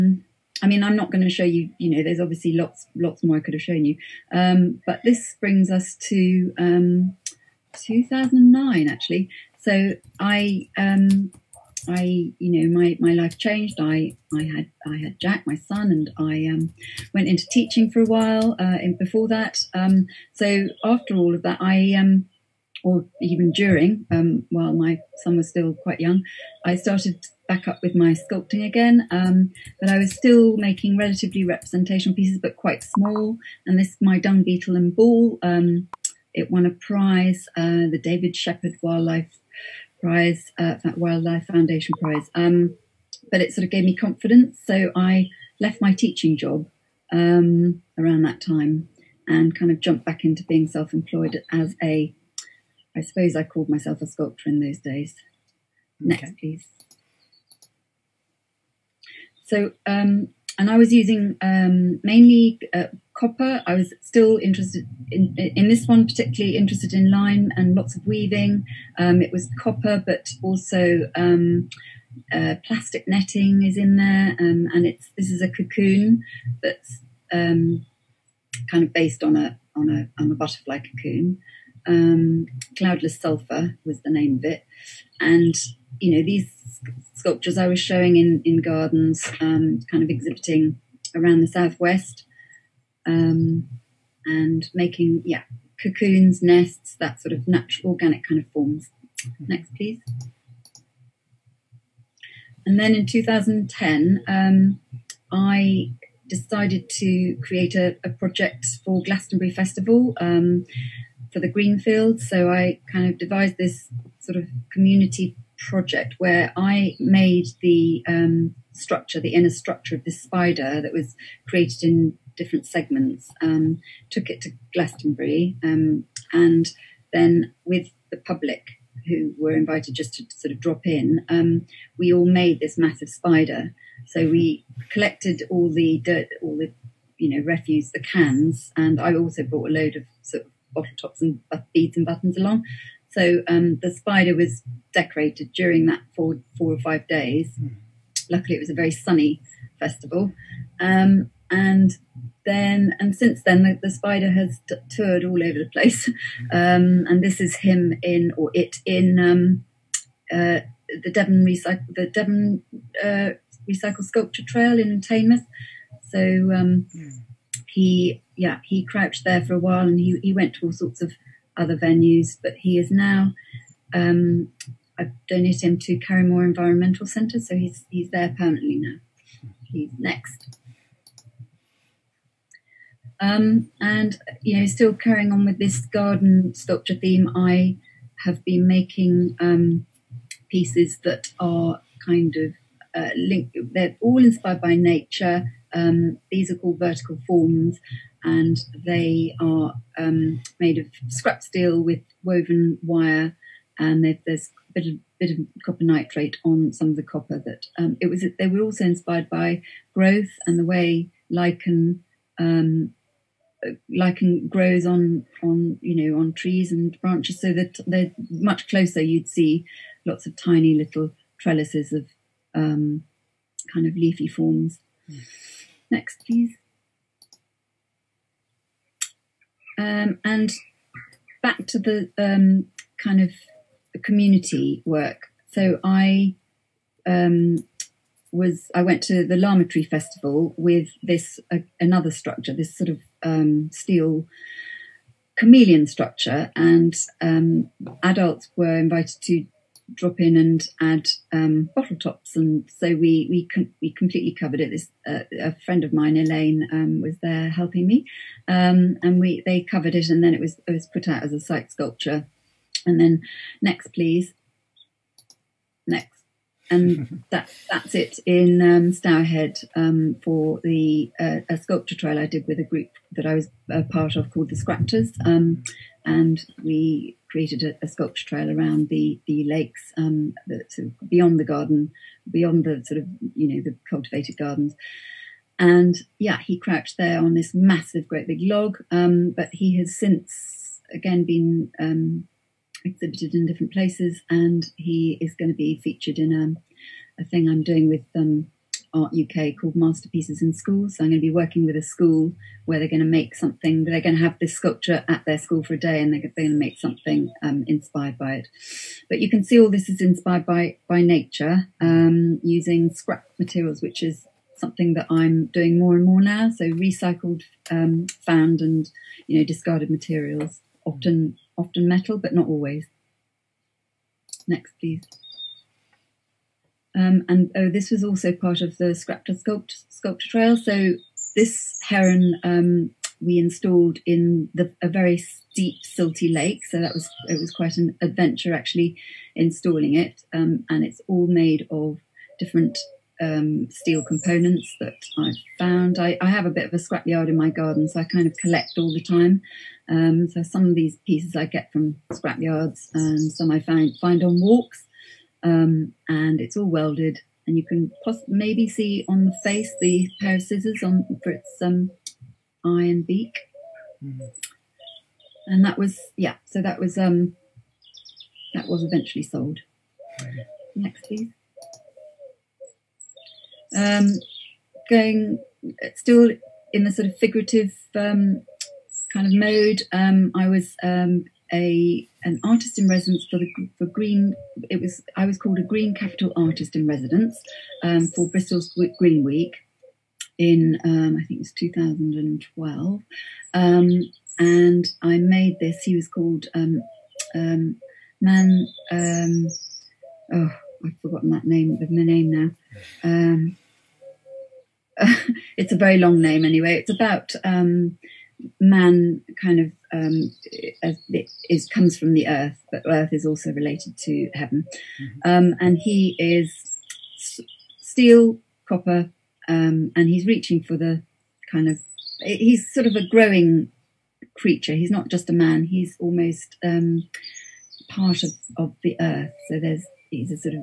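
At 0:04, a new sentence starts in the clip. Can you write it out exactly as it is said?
Um, but this brings us to um, 2009, actually.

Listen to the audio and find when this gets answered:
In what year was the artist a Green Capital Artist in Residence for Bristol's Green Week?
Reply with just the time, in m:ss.
6:31.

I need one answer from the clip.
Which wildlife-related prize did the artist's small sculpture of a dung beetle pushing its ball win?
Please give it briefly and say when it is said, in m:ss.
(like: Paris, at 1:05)
David Shepherd Wildlife prize, at 0:38.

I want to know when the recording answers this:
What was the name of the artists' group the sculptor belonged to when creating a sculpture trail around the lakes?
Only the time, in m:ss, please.
4:34.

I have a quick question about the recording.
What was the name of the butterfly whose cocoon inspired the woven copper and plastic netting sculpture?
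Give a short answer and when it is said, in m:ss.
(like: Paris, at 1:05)
Cloudless sulfur, at 1:22.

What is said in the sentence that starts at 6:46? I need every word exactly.
It's about um, man kind of um, it is comes from the earth, but earth is also related to heaven.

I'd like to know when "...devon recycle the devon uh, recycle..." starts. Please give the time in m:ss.
2:41.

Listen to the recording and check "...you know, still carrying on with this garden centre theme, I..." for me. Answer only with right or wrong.
wrong.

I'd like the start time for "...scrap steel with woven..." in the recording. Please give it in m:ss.
3:21.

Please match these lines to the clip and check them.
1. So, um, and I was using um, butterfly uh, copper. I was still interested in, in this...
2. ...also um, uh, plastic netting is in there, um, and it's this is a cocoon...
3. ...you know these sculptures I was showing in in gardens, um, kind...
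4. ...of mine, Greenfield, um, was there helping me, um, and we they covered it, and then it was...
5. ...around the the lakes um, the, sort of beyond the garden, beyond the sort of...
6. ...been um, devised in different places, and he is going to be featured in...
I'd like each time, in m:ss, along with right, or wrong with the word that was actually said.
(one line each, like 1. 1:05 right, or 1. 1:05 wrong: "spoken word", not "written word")
1. 0:59 wrong: "mainly", not "butterfly"
2. 1:10 right
3. 1:25 right
4. 4:15 wrong: "Elaine", not "Greenfield"
5. 4:38 right
6. 4:51 wrong: "exhibited", not "devised".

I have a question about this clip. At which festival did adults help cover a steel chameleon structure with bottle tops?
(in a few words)
Larmer Tree Festival.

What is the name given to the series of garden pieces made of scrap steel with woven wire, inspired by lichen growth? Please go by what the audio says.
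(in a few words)
Vertical forms.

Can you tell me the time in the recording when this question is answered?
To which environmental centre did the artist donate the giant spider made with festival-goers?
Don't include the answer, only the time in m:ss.
2:55.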